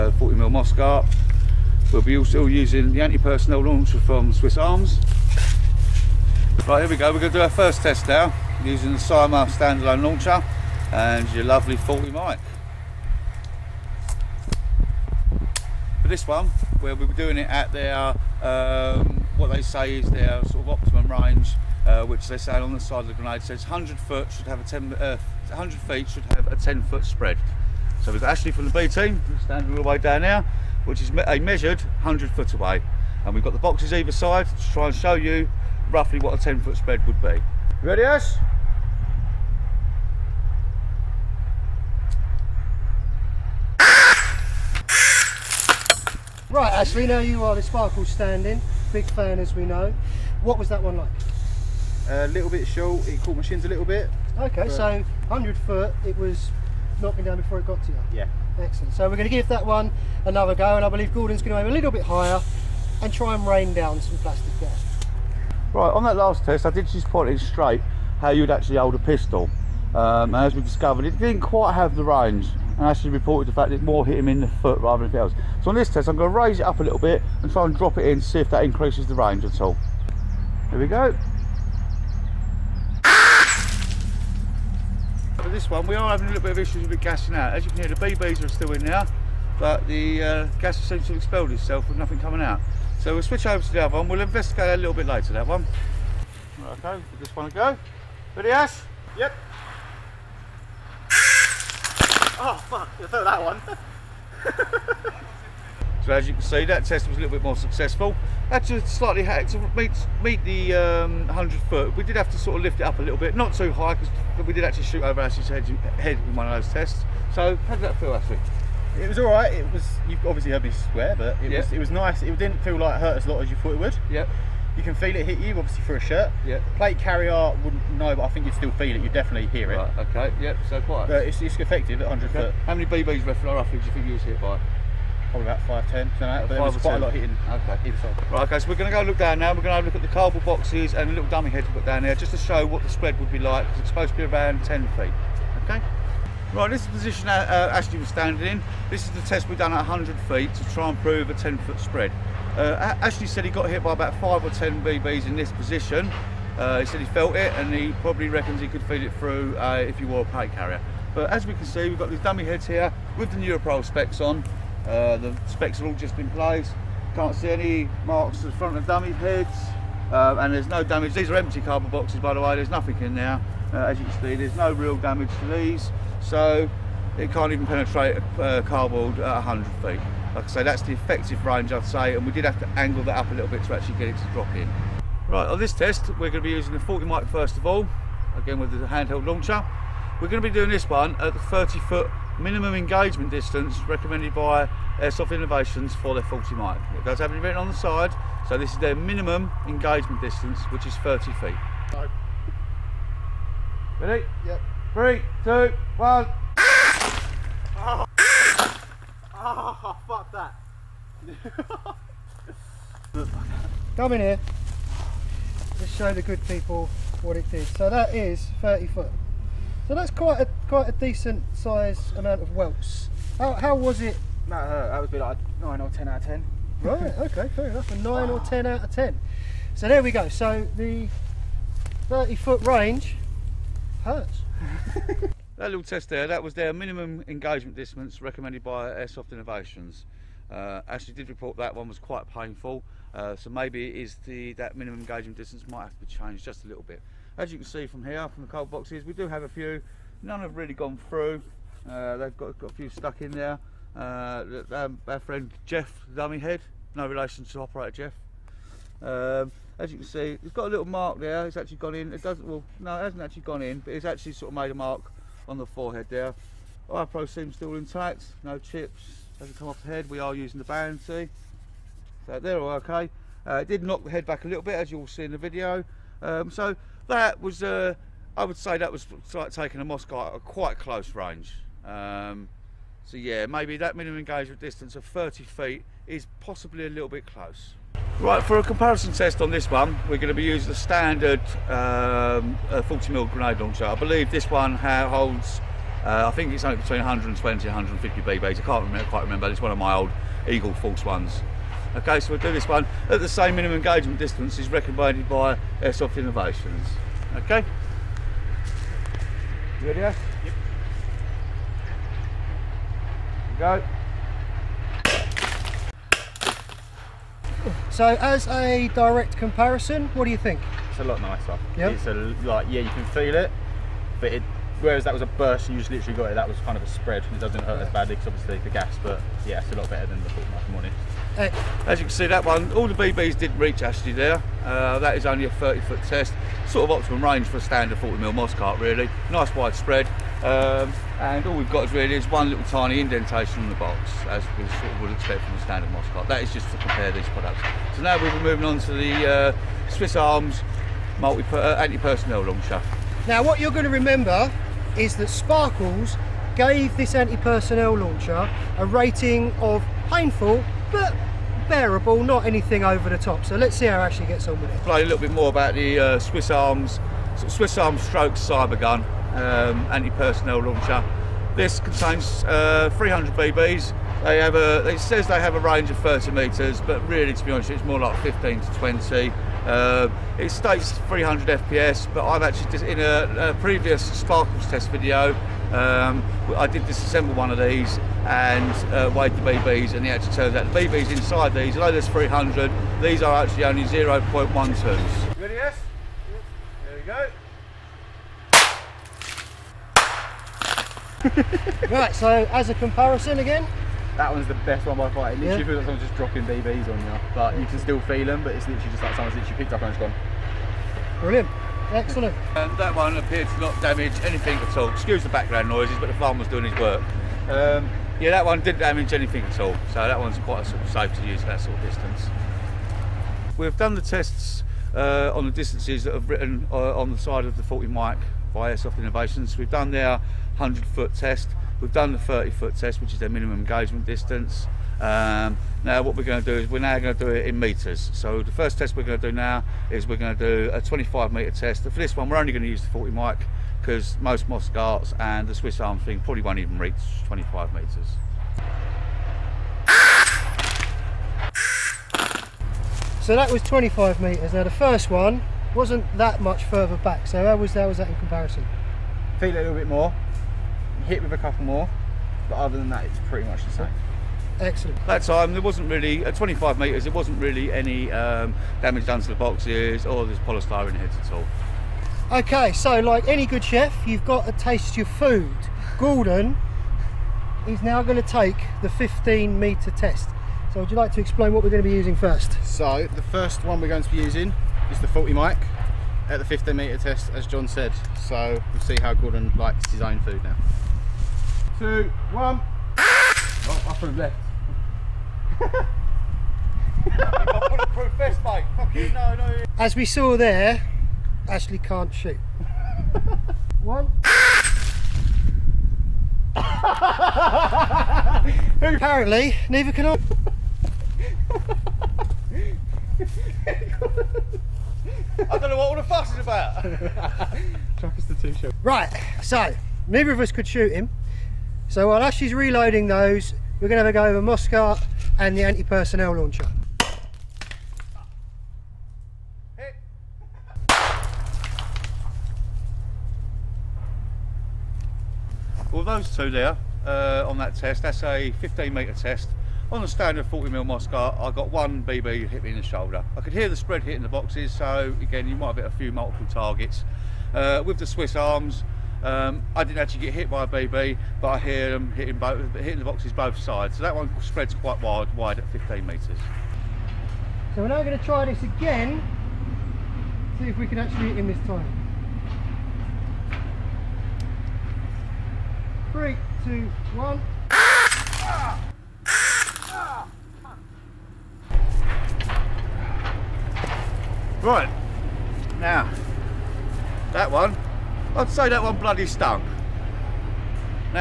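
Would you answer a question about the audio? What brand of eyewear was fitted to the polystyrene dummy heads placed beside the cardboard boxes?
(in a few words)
Nuprol.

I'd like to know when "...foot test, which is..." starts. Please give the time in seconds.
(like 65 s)
432 s.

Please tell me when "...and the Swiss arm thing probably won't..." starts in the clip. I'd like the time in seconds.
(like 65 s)
445 s.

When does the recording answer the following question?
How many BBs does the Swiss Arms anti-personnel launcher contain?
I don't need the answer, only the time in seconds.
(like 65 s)
372 s.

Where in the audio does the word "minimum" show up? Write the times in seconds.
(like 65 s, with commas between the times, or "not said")
192 s, 198 s, 236 s, 244 s, 283 s, 303 s, 433 s.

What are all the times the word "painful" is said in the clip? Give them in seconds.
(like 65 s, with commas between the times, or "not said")
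242 s, 360 s.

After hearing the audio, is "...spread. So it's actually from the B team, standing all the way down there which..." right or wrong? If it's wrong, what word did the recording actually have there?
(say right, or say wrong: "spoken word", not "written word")
right.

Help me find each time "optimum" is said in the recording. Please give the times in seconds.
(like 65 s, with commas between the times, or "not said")
20 s, 336 s.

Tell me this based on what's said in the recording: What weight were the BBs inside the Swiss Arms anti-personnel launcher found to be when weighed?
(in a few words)
0.12.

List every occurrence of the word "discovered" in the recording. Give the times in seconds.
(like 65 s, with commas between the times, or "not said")
70 s.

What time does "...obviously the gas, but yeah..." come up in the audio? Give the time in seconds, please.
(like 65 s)
328 s.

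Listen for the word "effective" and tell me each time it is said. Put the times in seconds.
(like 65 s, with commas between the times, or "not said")
131 s, 180 s.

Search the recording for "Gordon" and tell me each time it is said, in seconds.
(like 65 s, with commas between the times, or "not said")
61 s, 475 s, 489 s.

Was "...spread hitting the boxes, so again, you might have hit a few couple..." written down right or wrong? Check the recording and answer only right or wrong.
wrong.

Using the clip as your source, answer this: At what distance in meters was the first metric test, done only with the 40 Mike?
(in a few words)
25 meters.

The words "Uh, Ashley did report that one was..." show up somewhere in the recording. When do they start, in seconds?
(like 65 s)
240 s.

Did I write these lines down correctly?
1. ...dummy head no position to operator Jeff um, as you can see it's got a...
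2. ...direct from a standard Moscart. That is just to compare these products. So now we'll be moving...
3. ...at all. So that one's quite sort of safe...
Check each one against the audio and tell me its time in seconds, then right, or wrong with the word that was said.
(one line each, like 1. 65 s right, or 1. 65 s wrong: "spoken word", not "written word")
1. 256 s wrong: "relation", not "position"
2. 345 s wrong: "expect", not "direct"
3. 419 s right.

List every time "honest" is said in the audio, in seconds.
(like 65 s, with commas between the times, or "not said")
330 s, 377 s.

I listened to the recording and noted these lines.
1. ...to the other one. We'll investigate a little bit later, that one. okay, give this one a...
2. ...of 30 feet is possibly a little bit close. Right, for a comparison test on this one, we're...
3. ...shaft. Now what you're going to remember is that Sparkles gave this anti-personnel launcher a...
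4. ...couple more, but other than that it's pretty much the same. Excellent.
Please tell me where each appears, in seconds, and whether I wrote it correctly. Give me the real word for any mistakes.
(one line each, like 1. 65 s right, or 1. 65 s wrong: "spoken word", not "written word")
1. 93 s right
2. 284 s right
3. 352 s right
4. 461 s right.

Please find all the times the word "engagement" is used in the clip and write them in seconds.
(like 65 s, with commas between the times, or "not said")
192 s, 199 s, 237 s, 244 s, 284 s, 303 s, 433 s.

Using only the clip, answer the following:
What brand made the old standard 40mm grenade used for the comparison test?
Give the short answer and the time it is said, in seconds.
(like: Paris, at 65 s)
Eagle Force, at 300 s.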